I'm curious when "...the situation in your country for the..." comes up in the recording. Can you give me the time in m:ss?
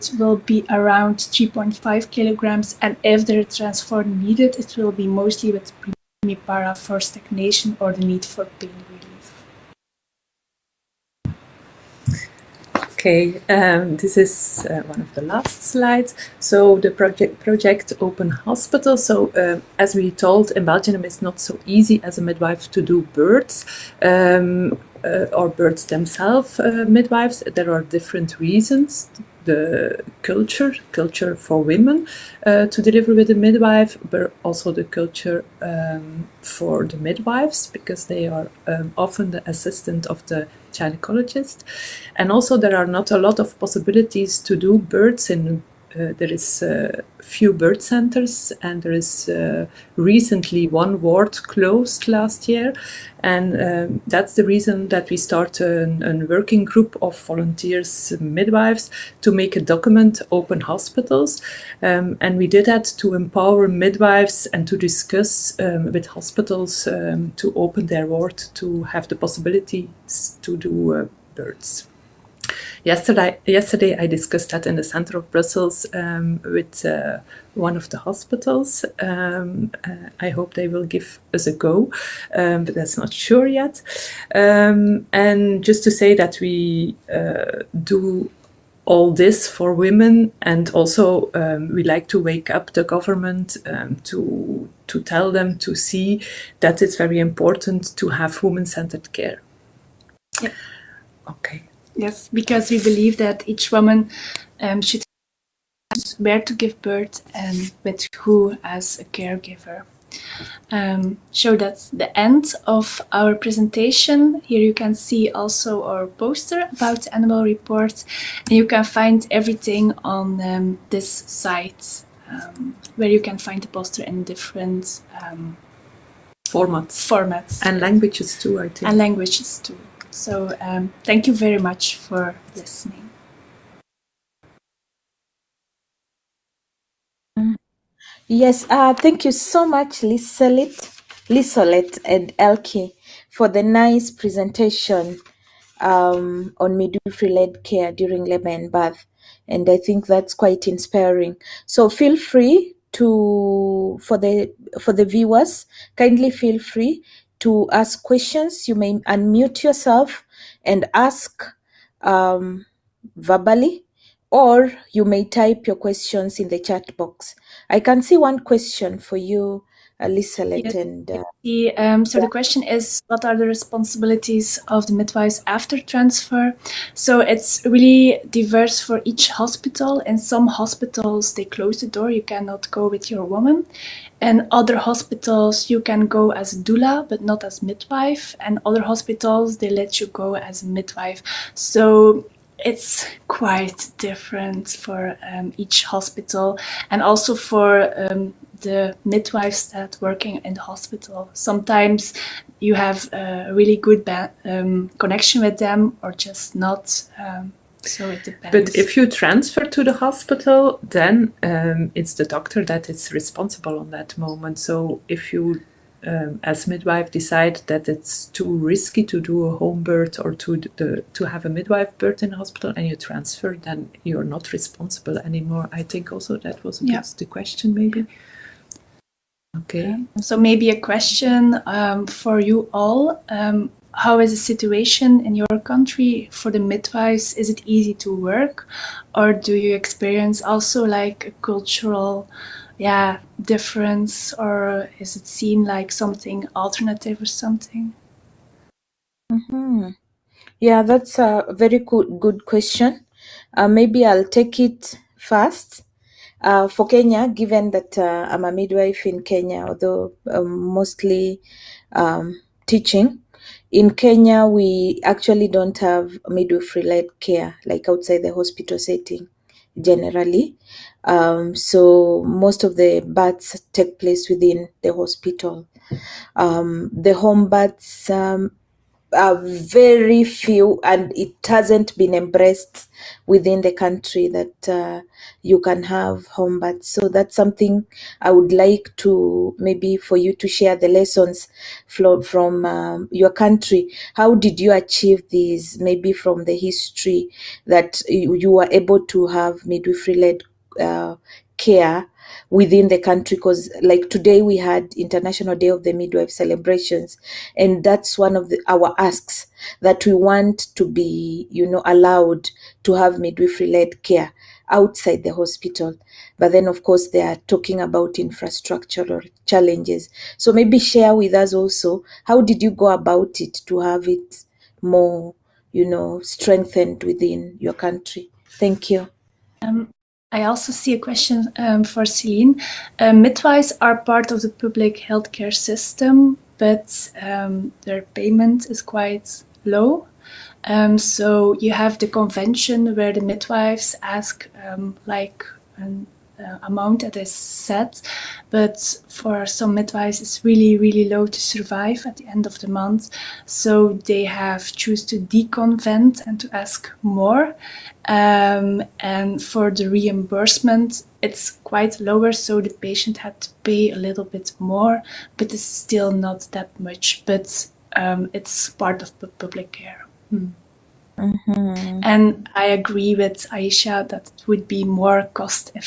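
3:54.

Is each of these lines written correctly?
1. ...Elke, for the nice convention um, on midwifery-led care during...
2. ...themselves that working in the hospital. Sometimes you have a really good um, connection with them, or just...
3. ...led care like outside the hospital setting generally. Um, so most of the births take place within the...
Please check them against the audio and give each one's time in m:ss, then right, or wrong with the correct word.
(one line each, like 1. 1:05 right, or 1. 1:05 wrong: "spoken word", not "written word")
1. 2:22 wrong: "presentation", not "convention"
2. 3:19 wrong: "midwives", not "themselves"
3. 4:26 right.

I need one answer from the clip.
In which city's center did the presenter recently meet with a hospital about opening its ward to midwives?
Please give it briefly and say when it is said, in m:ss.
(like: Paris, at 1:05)
Brussels, at 1:15.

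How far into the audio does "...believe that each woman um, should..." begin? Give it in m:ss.
1:42.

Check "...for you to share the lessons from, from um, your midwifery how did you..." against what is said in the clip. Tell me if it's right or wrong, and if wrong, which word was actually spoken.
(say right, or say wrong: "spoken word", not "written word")
wrong: "country", not "midwifery".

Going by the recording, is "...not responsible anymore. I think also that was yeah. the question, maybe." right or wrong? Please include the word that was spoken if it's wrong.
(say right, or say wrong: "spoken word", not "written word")
right.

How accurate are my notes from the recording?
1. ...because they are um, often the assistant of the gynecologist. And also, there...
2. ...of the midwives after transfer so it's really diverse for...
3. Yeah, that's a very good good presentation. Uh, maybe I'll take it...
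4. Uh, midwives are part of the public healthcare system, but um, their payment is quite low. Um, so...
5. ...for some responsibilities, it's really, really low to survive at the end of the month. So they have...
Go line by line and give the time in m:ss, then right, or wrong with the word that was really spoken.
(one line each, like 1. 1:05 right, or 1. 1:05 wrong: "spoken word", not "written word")
1. 0:37 right
2. 2:54 right
3. 4:10 wrong: "question", not "presentation"
4. 5:32 right
5. 5:49 wrong: "midwives", not "responsibilities".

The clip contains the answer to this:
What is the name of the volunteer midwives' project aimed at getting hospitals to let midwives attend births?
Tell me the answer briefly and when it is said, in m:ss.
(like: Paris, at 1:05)
Open Hospital, at 0:17.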